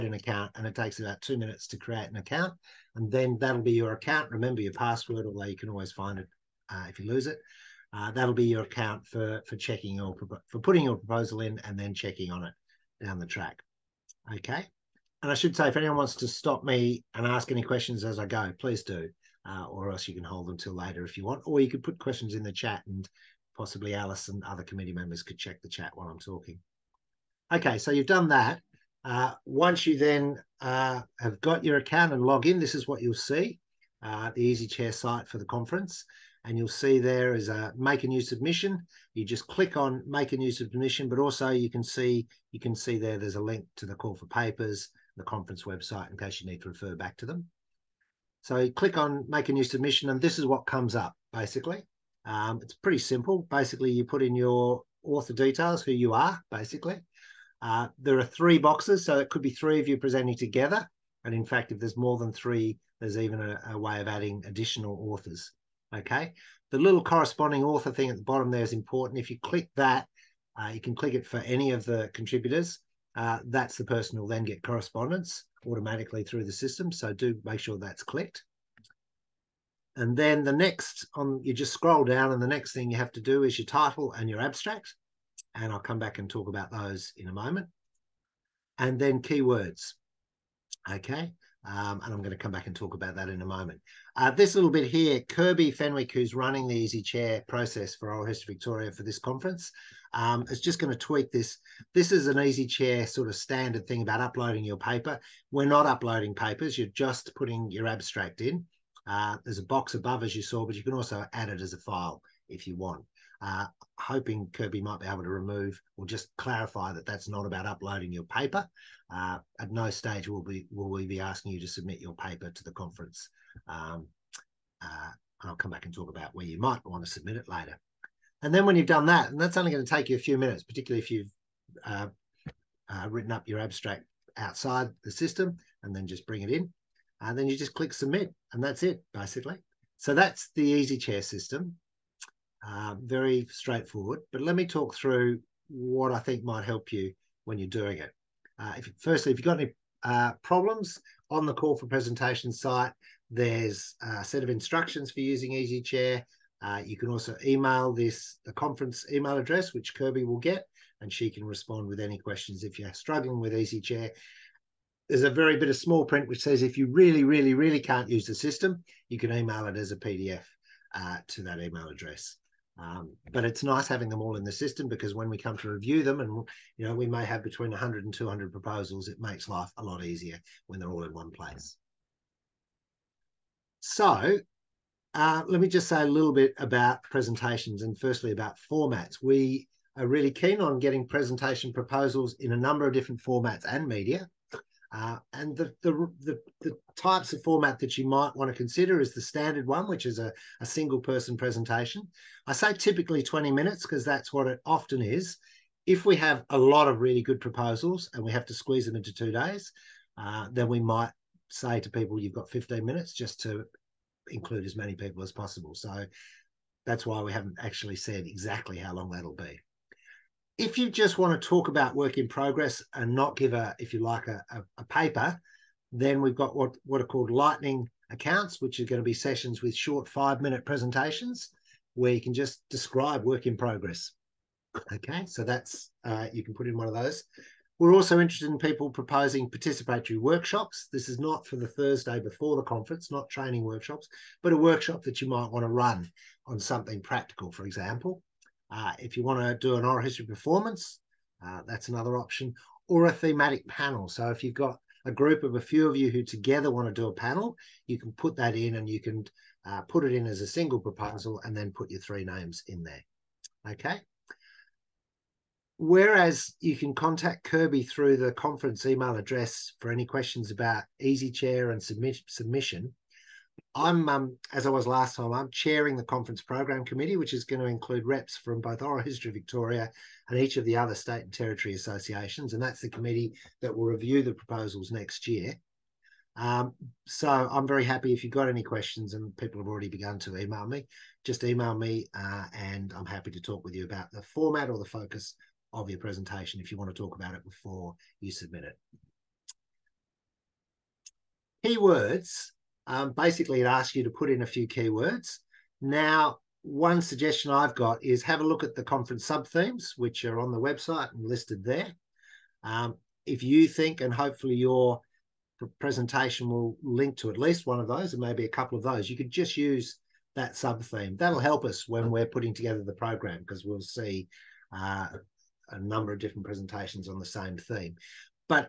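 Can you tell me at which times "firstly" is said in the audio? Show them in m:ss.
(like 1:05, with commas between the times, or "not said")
2:29, 3:07.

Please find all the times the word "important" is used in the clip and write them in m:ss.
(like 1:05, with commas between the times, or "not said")
1:08.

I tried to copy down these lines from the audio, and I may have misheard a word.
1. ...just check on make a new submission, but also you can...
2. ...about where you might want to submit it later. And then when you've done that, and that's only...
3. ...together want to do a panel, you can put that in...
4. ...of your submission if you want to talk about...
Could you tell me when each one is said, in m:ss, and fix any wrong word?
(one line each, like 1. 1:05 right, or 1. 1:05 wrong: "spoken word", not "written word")
1. 0:39 wrong: "click", not "check"
2. 2:06 right
3. 4:16 right
4. 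4:55 wrong: "presentation", not "submission".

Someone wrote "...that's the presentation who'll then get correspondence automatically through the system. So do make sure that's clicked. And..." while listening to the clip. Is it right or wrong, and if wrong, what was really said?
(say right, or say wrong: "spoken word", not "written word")
wrong: "person", not "presentation".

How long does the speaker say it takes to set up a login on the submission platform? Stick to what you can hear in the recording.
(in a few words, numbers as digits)
2 minutes.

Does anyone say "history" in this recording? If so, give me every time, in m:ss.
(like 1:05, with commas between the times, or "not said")
1:38, 4:10, 4:39.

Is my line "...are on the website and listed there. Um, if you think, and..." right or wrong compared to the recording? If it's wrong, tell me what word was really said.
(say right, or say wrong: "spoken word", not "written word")
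right.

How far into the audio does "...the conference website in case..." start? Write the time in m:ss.
0:45.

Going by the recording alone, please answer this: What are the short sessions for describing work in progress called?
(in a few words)
lightning accounts.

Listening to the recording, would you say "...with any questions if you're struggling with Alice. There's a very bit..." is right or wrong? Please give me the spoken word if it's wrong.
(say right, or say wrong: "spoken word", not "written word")
wrong: "EasyChair", not "Alice".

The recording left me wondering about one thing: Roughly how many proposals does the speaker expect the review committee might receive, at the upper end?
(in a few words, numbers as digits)
200.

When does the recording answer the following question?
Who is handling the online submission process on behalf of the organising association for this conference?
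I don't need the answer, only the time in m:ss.
1:35.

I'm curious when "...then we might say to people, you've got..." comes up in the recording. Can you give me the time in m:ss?
3:30.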